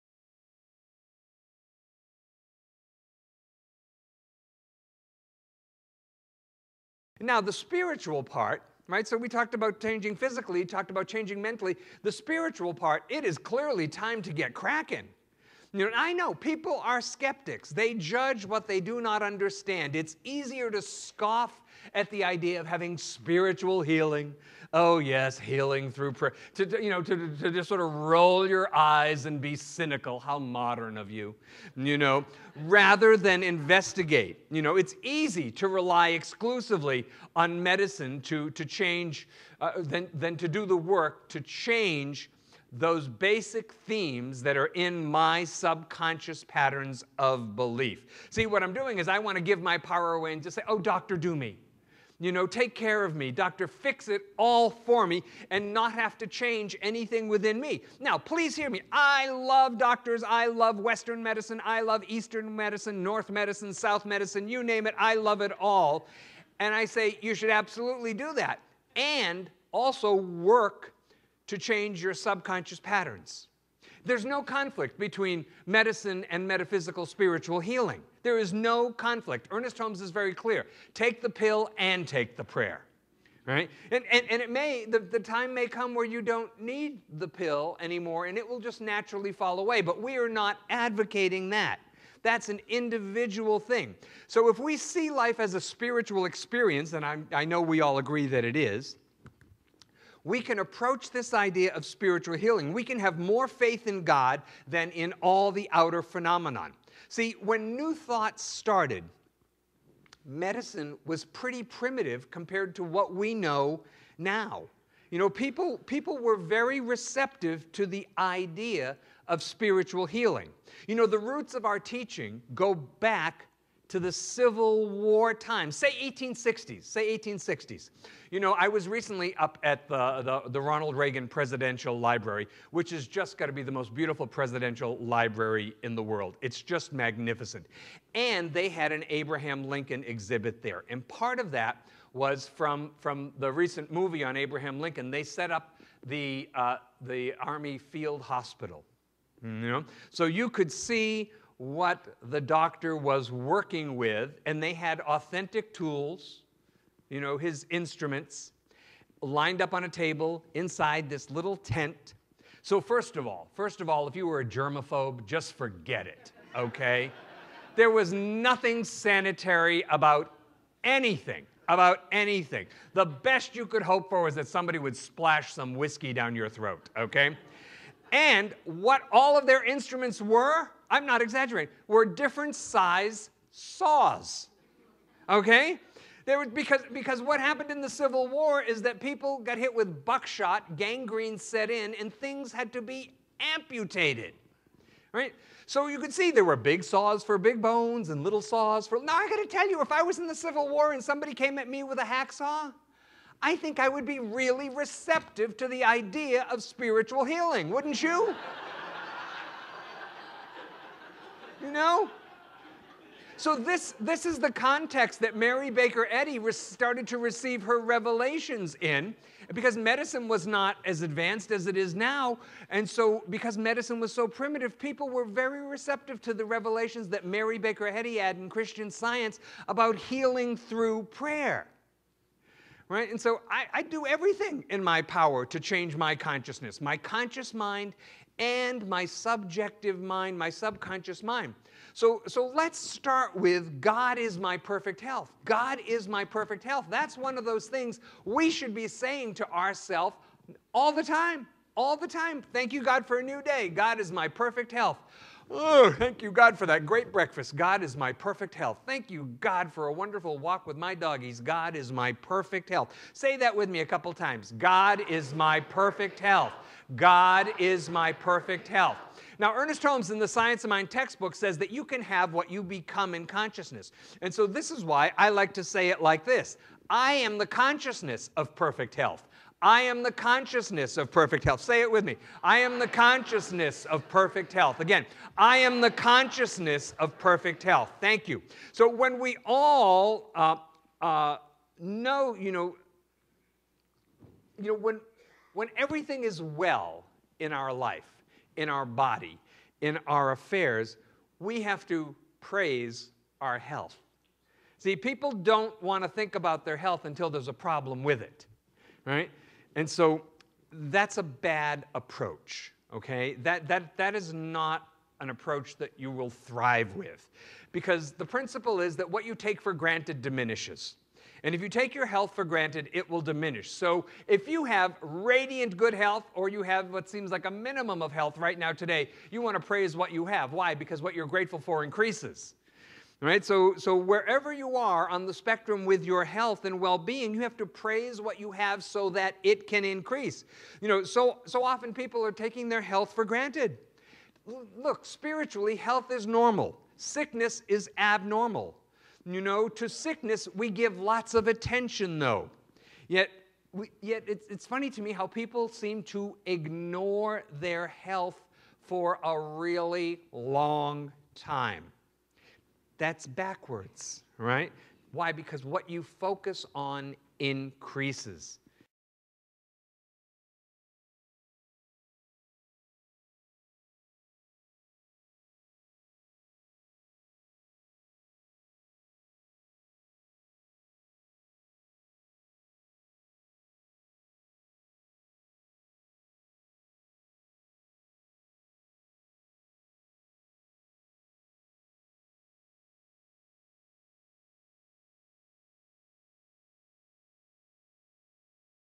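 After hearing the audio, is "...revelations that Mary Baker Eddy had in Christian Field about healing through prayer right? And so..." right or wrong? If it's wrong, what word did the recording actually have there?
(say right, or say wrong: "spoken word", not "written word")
wrong: "Science", not "Field".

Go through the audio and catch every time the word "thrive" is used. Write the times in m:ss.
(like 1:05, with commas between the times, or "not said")
5:16.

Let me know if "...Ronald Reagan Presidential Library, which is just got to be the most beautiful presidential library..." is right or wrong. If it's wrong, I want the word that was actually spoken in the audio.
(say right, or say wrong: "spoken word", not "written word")
right.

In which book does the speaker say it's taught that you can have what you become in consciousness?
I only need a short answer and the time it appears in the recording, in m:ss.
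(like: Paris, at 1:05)
Science of Mind, at 4:30.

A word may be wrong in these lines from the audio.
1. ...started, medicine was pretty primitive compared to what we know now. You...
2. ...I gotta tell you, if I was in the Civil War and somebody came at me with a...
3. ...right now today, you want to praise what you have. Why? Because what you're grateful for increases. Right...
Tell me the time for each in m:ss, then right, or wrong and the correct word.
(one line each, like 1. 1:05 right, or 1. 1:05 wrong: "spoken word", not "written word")
1. 1:48 right
2. 3:19 right
3. 5:28 right.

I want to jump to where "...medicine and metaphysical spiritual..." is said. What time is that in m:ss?
1:15.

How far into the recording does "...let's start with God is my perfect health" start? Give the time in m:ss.
4:02.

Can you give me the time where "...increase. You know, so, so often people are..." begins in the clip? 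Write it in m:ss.
5:39.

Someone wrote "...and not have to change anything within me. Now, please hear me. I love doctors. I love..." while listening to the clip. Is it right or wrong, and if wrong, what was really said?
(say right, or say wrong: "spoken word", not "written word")
right.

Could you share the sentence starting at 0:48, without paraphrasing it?
See, what I'm doing is I want to give my power away and just say, oh, doctor, do me.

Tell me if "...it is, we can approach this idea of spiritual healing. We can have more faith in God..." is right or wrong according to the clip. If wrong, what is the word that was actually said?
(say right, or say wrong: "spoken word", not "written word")
right.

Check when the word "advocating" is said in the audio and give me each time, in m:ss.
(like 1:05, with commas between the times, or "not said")
1:30.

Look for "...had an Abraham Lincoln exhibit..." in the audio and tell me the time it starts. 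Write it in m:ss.
2:18.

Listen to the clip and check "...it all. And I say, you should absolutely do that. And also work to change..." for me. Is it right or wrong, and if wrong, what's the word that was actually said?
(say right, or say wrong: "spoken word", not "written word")
right.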